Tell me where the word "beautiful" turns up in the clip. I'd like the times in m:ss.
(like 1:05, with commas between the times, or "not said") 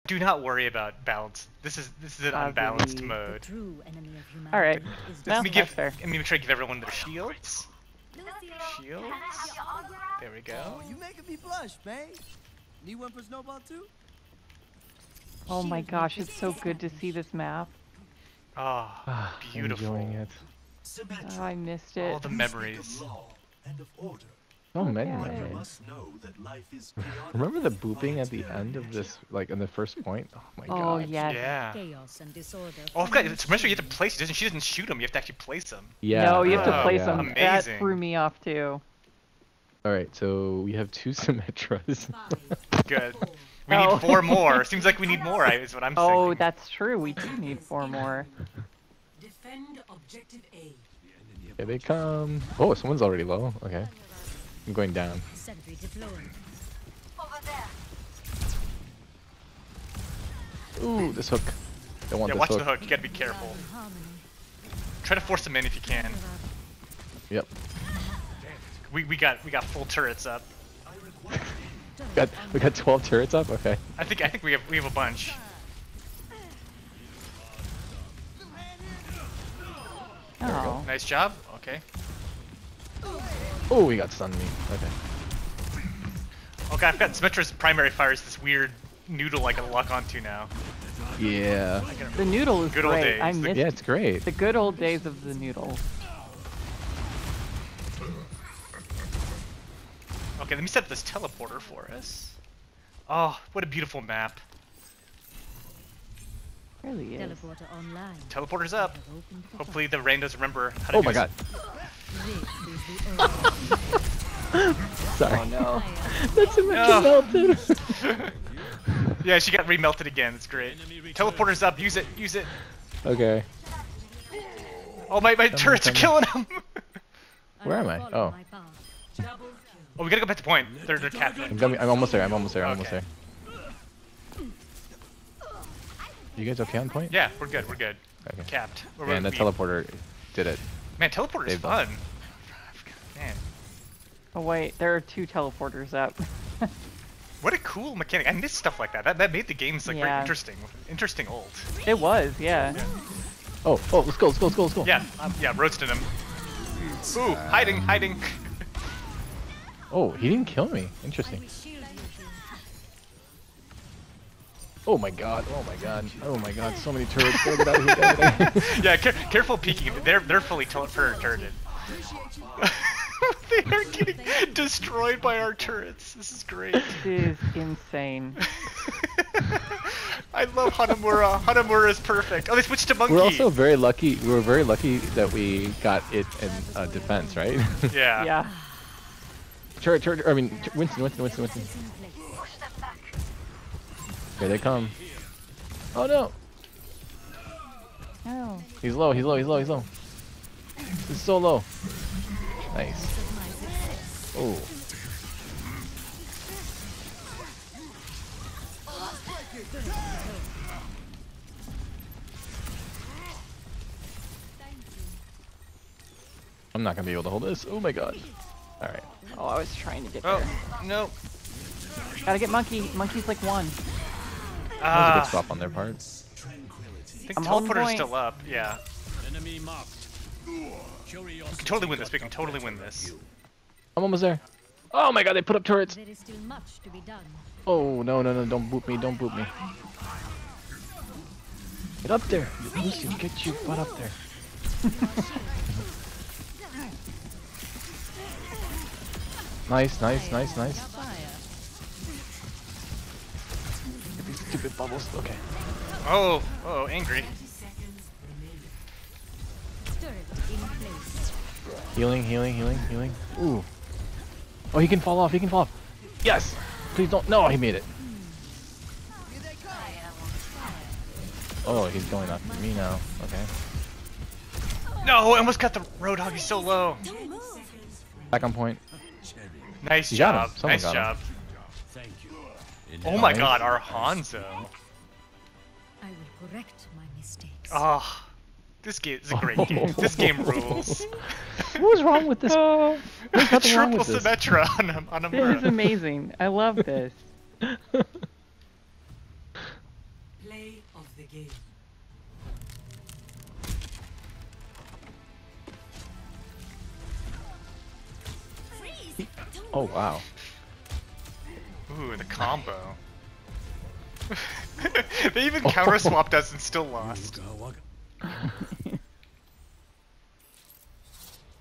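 0:19, 1:43.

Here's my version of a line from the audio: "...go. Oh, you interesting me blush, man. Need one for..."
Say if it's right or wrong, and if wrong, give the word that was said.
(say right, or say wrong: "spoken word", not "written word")
wrong: "making", not "interesting".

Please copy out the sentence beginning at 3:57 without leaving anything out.
Oh, no, no, no, don't boot me, don't boot me.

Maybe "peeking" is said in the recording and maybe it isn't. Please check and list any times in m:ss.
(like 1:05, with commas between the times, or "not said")
2:49.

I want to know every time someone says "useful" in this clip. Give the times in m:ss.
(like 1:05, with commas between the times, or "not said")
not said.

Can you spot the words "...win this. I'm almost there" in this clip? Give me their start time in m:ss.
3:52.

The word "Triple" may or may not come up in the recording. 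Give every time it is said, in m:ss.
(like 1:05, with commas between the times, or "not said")
4:53.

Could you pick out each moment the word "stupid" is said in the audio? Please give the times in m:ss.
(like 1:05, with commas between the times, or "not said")
4:14.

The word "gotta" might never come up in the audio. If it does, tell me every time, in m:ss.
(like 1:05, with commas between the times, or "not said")
1:02, 2:10, 3:42.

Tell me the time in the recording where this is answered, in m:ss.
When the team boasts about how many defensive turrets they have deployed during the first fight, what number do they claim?
1:12.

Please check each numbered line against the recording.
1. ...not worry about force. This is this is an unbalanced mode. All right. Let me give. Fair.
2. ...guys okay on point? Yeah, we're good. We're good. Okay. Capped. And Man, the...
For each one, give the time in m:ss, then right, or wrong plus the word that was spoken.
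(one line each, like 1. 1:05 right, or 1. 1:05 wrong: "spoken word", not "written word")
1. 0:00 wrong: "balance", not "force"
2. 2:16 right.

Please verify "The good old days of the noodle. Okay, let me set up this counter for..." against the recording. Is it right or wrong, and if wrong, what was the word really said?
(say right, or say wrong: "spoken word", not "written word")
wrong: "teleporter", not "counter".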